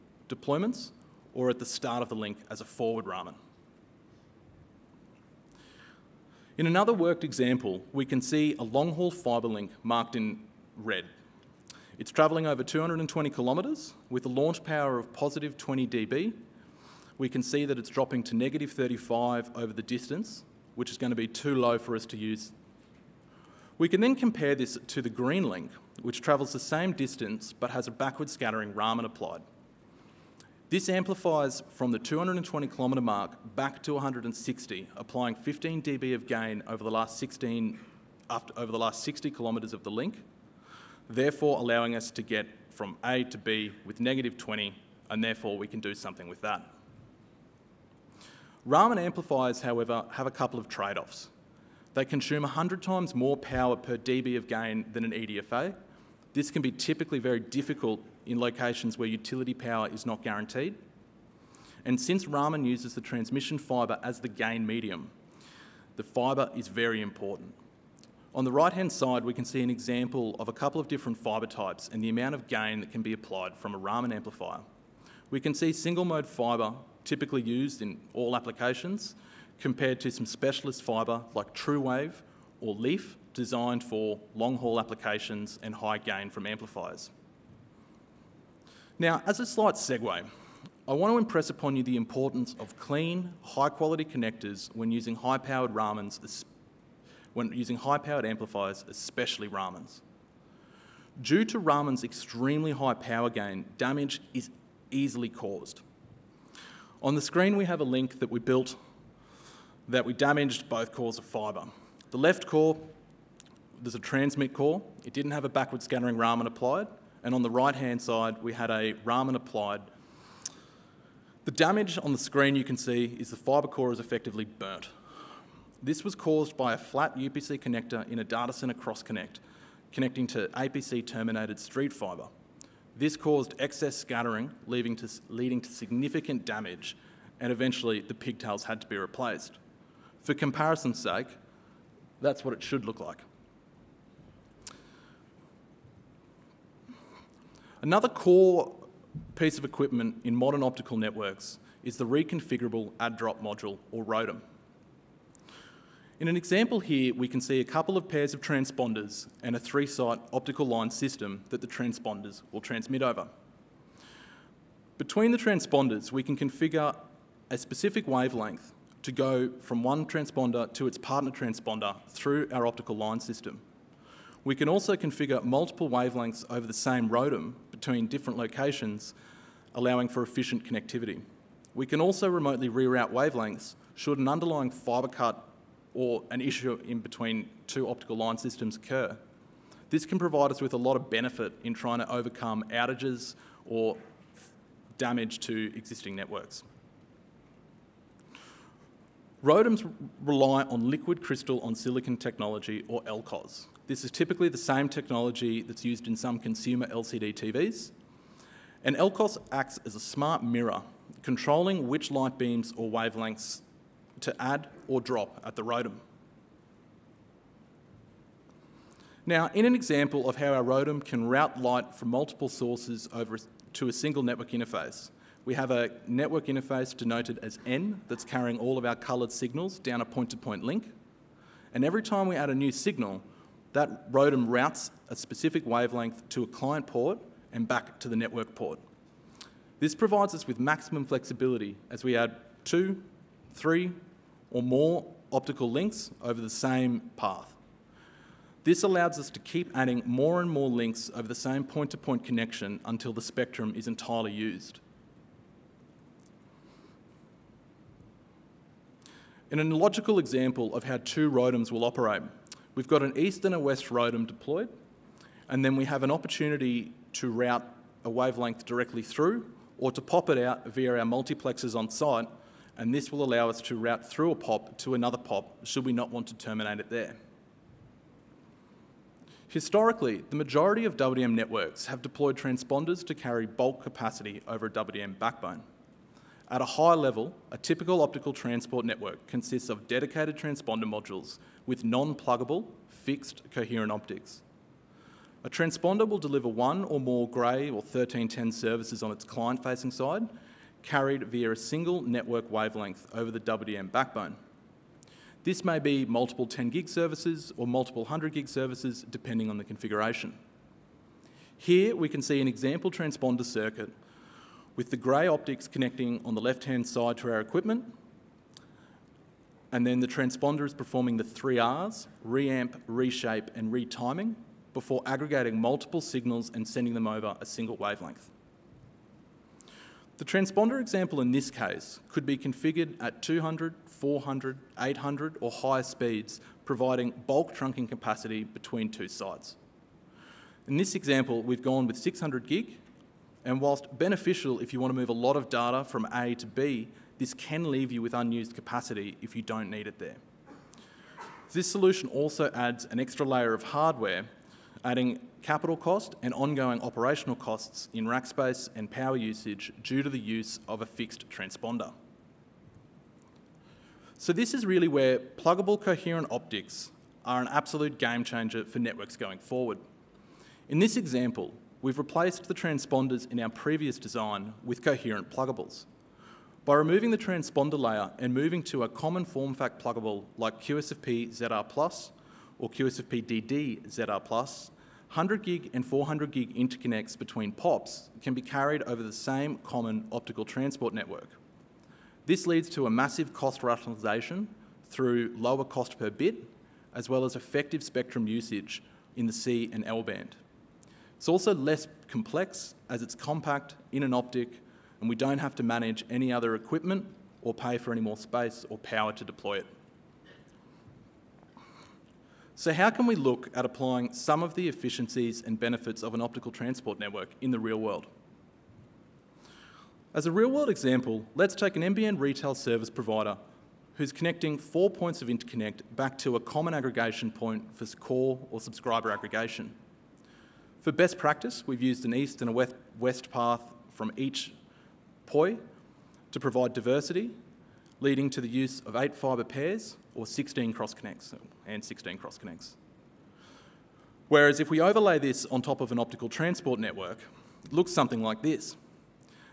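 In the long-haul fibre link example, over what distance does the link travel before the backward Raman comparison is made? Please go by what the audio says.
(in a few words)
220 kilometres.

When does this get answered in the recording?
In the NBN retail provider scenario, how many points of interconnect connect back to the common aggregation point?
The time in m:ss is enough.
7:04.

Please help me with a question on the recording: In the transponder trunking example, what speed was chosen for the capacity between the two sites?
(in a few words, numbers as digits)
600 gig.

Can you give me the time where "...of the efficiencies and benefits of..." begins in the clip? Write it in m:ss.
6:54.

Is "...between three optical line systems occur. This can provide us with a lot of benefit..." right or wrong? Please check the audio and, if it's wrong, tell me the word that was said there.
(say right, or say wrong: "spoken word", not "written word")
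wrong: "two", not "three".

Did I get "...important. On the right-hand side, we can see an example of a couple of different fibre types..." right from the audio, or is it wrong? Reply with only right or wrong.
right.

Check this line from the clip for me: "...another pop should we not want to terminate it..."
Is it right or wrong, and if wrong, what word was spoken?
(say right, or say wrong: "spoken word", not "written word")
right.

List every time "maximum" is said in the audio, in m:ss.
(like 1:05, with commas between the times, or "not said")
4:00.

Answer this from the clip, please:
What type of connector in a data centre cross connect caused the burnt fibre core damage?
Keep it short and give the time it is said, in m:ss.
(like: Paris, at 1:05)
flat UPC connector, at 2:06.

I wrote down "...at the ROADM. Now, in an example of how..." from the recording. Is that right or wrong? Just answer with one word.
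right.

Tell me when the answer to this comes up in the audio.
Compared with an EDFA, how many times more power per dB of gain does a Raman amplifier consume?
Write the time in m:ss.
0:52.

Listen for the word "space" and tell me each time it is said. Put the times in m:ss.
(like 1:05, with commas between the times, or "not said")
5:58, 6:48.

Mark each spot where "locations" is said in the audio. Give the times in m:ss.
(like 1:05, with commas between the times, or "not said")
0:58, 2:58.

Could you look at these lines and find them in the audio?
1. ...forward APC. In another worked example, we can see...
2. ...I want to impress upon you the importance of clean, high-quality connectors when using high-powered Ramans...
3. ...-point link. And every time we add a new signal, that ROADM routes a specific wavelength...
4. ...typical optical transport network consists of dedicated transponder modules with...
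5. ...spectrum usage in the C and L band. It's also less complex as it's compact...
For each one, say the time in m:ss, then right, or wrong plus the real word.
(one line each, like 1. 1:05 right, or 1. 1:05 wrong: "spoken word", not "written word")
1. 0:02 wrong: "Raman", not "APC"
2. 1:30 right
3. 3:50 right
4. 4:47 right
5. 6:37 right.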